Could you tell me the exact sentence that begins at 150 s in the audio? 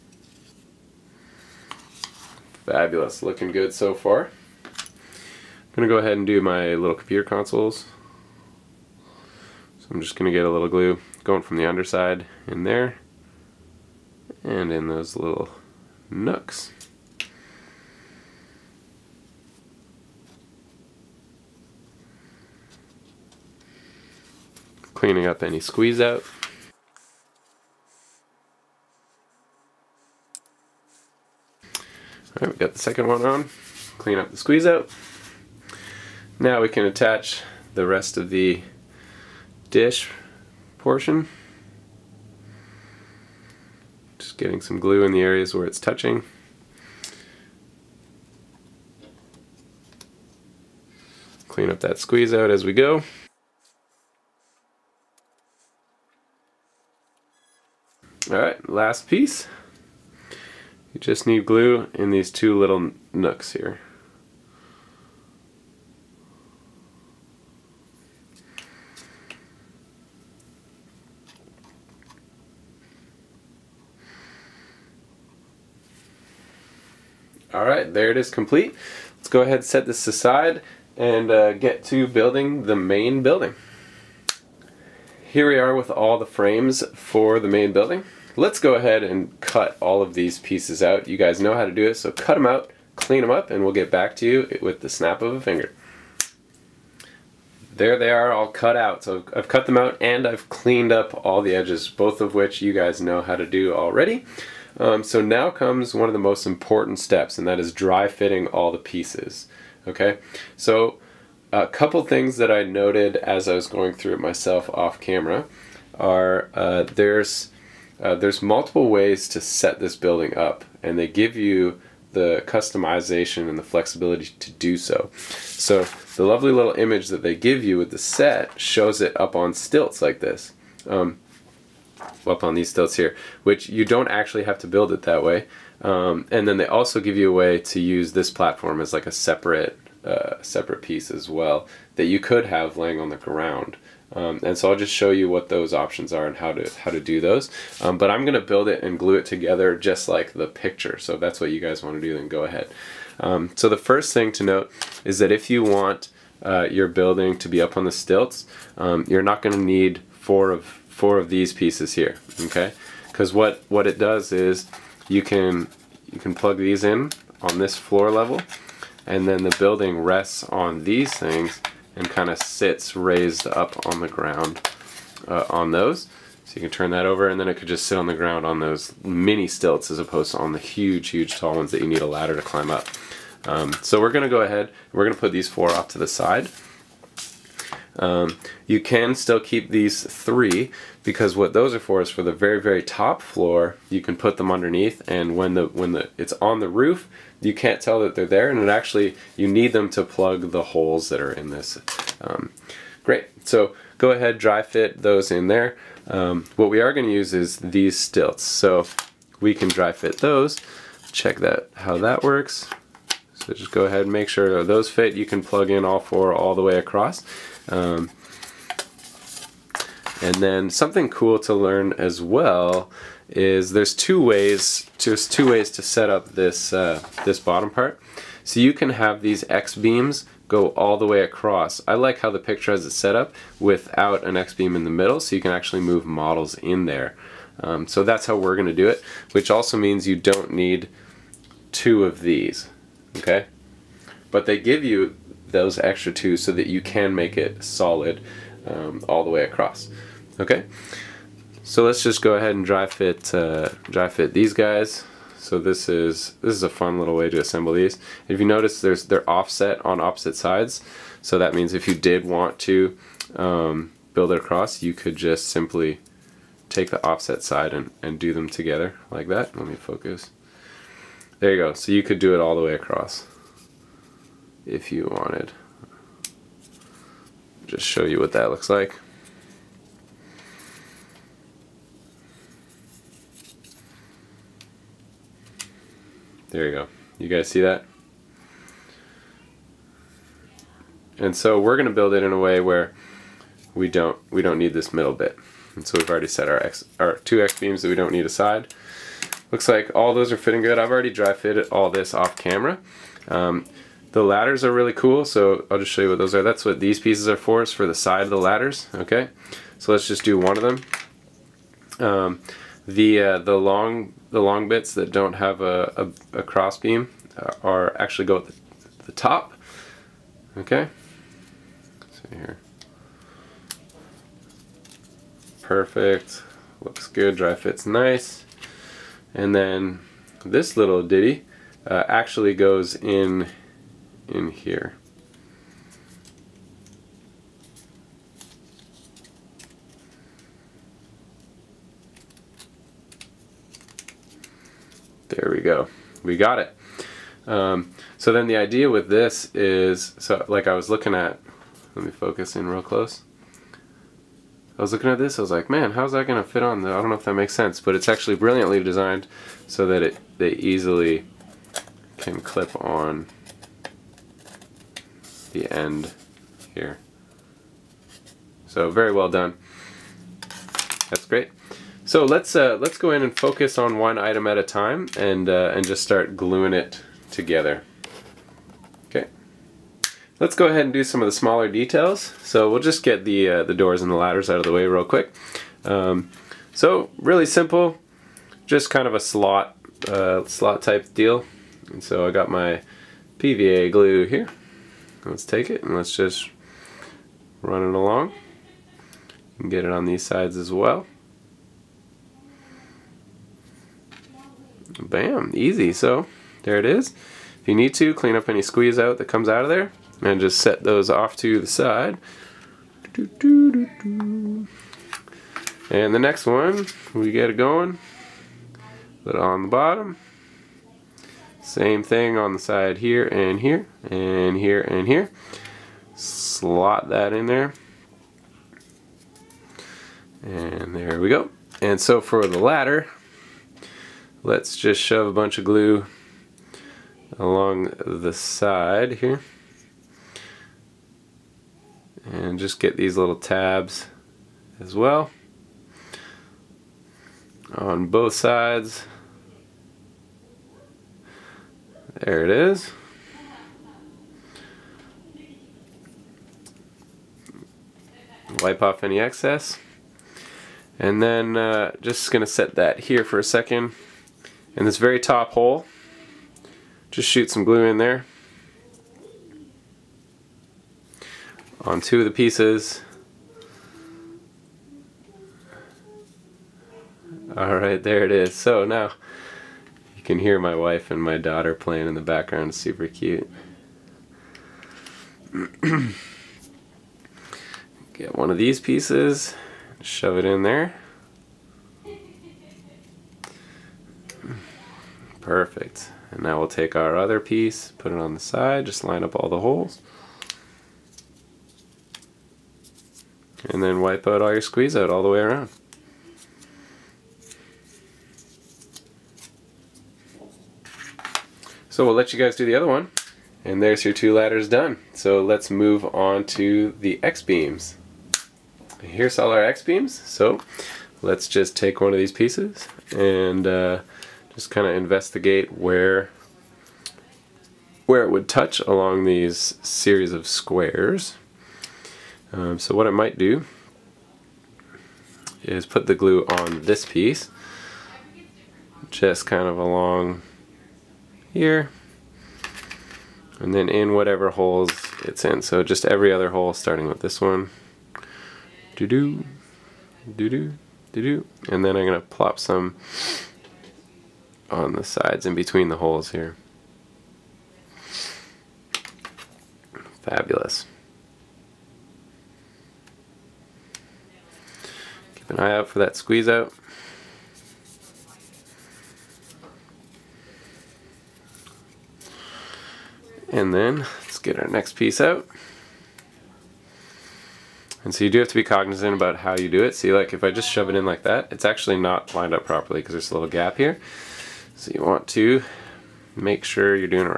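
So if that's what you guys want to do, then go ahead.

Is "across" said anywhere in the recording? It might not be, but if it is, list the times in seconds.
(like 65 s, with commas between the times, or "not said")
216 s, 231 s, 249 s, 264 s, 272 s.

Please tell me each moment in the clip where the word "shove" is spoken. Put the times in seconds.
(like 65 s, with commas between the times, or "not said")
435 s, 490 s, 580 s.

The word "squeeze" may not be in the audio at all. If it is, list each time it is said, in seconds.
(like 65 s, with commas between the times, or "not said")
25 s, 34 s, 51 s, 408 s, 504 s, 566 s.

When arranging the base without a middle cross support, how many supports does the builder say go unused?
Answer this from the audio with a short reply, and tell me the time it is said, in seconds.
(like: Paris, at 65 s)
2, at 240 s.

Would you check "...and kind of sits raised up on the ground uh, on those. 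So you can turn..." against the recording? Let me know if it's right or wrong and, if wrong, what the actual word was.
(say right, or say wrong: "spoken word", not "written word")
right.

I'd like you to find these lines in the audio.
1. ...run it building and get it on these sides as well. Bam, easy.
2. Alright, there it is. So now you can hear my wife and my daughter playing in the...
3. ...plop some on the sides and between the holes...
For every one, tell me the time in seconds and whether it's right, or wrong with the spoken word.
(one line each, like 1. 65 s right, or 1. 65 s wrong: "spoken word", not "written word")
1. 397 s wrong: "along", not "building"
2. 477 s right
3. 552 s right.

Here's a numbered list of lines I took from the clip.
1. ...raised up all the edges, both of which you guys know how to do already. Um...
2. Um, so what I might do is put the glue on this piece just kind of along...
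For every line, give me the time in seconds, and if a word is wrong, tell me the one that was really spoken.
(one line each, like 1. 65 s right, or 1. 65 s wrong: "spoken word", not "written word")
1. 100 s wrong: "cleaned", not "raised"
2. 532 s right.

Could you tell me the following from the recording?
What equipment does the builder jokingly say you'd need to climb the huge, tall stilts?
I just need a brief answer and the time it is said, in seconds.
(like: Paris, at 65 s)
A ladder, at 182 s.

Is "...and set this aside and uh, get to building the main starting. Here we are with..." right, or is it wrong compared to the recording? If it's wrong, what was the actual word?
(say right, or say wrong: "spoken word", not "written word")
wrong: "building", not "starting".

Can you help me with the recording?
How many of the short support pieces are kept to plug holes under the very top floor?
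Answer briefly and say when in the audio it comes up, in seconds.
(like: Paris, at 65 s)
3, at 189 s.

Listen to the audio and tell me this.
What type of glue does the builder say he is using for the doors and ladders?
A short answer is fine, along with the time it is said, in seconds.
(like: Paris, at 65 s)
PVA glue, at 393 s.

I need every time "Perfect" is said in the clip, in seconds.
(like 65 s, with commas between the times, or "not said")
325 s, 495 s.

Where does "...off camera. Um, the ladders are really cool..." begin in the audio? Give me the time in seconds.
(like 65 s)
302 s.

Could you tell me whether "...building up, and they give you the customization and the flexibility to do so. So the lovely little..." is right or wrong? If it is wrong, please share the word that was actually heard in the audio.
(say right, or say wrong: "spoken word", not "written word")
right.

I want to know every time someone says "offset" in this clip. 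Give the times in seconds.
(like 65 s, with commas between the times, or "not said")
259 s, 267 s.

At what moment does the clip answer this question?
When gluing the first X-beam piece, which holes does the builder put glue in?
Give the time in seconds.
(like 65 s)
546 s.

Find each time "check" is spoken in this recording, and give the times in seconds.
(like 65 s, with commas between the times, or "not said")
211 s.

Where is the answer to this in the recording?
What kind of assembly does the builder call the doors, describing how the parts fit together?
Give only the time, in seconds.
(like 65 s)
390 s.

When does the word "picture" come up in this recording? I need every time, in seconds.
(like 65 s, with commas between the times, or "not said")
150 s, 232 s.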